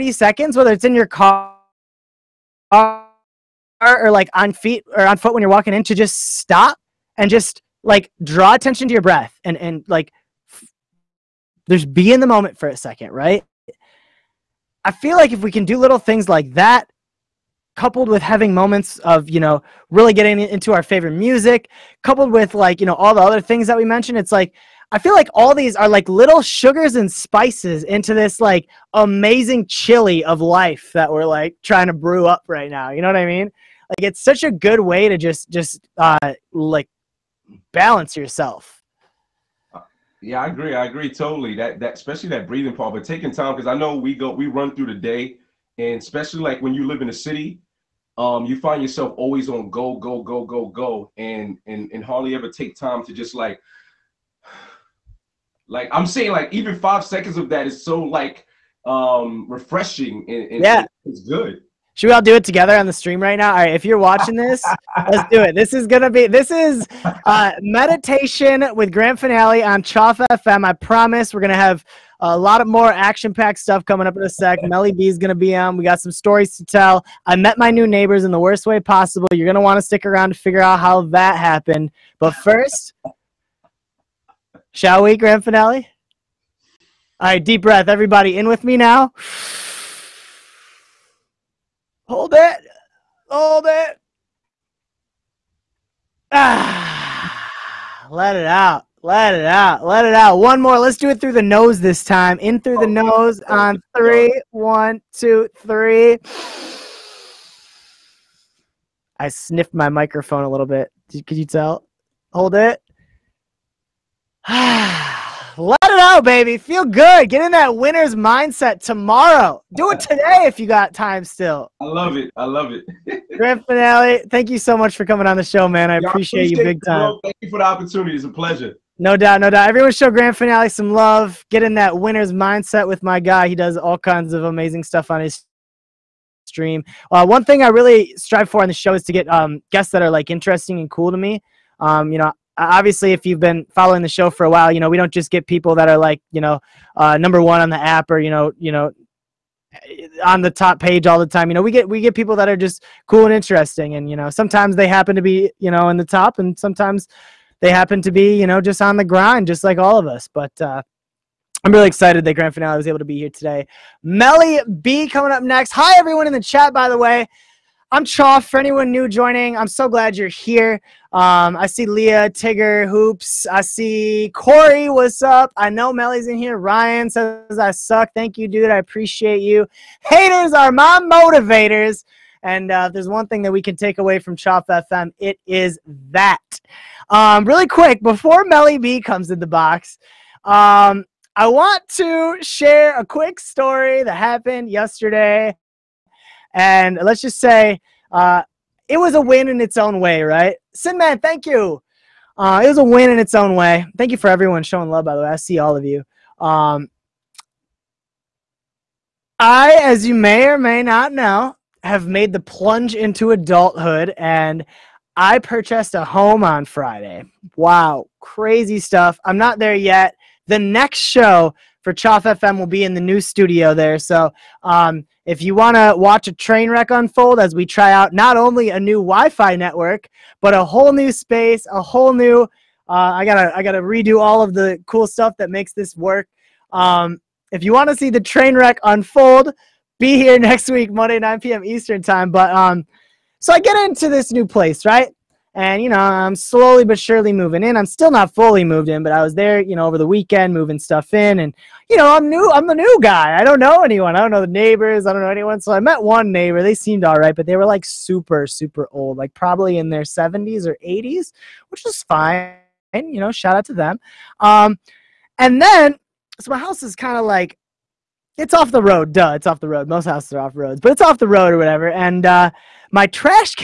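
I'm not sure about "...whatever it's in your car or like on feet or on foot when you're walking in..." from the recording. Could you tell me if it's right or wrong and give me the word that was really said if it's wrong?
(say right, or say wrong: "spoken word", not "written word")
wrong: "whether", not "whatever".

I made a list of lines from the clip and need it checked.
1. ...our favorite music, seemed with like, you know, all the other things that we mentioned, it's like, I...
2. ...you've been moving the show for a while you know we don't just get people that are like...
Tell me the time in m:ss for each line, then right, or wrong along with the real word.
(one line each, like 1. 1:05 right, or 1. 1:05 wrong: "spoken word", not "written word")
1. 0:20 wrong: "coupled", not "seemed"
2. 2:23 wrong: "following", not "moving".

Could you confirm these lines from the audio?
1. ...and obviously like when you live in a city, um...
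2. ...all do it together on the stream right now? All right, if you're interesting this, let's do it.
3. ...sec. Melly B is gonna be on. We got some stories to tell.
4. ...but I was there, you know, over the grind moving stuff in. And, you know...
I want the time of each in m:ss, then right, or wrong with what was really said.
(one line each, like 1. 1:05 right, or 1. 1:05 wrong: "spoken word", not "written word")
1. 0:45 wrong: "especially", not "obviously"
2. 1:02 wrong: "watching", not "interesting"
3. 1:14 right
4. 4:09 wrong: "weekend", not "grind".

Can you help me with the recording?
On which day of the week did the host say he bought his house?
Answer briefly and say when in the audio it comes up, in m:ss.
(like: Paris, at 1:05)
Friday, at 3:36.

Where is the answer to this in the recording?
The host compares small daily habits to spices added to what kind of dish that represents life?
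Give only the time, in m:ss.
0:29.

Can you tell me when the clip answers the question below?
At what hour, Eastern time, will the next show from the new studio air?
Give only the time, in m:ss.
4:01.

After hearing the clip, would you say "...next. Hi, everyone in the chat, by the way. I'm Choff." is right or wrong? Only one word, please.
right.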